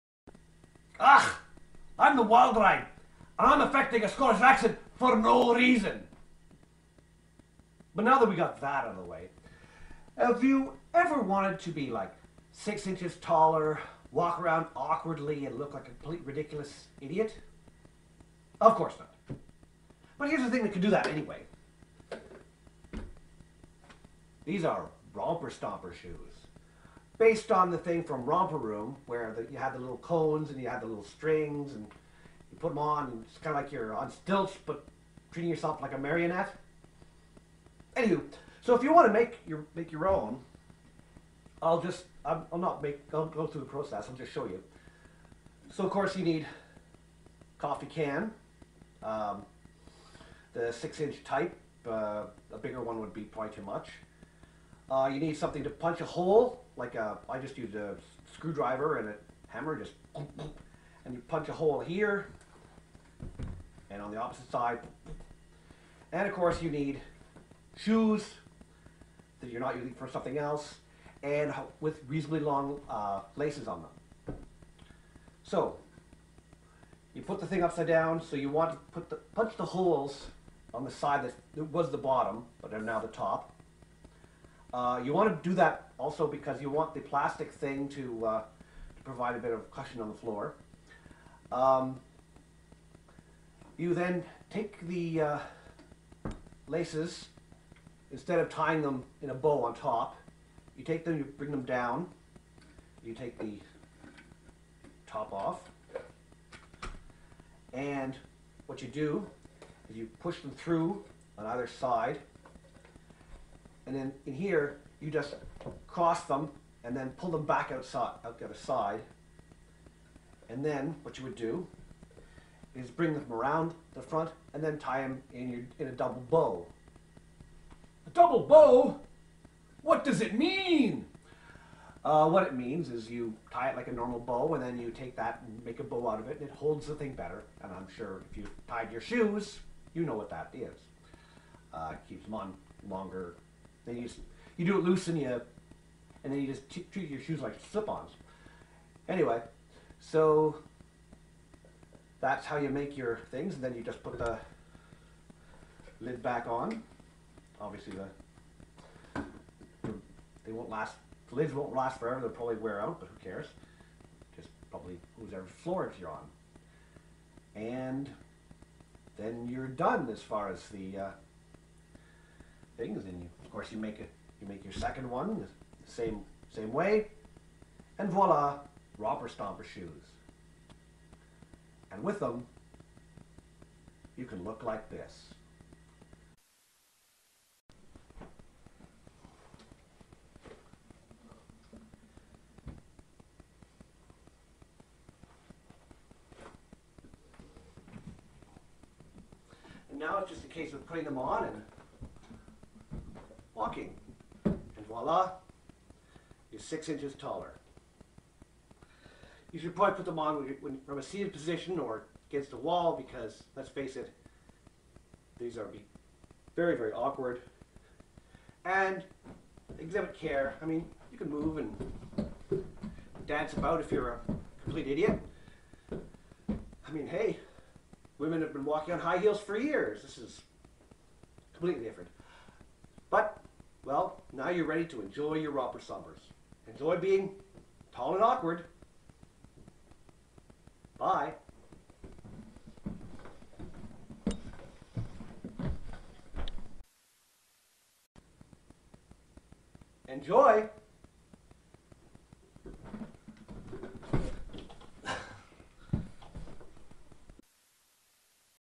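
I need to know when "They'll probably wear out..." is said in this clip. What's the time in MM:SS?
02:42.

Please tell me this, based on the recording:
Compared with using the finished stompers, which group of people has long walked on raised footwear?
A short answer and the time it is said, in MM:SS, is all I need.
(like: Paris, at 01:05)
women, at 03:48.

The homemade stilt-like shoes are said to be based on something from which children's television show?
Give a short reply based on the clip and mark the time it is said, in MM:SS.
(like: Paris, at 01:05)
Romper Room, at 00:28.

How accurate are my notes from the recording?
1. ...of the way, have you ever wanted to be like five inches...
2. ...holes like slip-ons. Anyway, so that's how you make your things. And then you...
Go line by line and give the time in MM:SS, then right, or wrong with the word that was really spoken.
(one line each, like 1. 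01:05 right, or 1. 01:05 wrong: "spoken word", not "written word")
1. 00:08 wrong: "six", not "five"
2. 02:27 wrong: "shoes", not "holes".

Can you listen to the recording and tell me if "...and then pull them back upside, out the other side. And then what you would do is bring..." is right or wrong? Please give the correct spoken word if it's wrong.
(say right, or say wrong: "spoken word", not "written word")
wrong: "outside", not "upside".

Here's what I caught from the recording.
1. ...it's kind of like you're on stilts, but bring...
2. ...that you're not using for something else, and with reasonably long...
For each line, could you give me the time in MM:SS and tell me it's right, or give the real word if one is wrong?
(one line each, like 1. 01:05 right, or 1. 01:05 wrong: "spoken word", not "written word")
1. 00:33 wrong: "treating", not "bring"
2. 01:09 right.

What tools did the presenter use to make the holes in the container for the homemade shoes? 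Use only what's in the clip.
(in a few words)
a screwdriver and a hammer.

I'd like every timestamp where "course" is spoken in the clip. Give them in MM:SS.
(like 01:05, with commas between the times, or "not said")
00:18, 00:45, 01:06, 02:53.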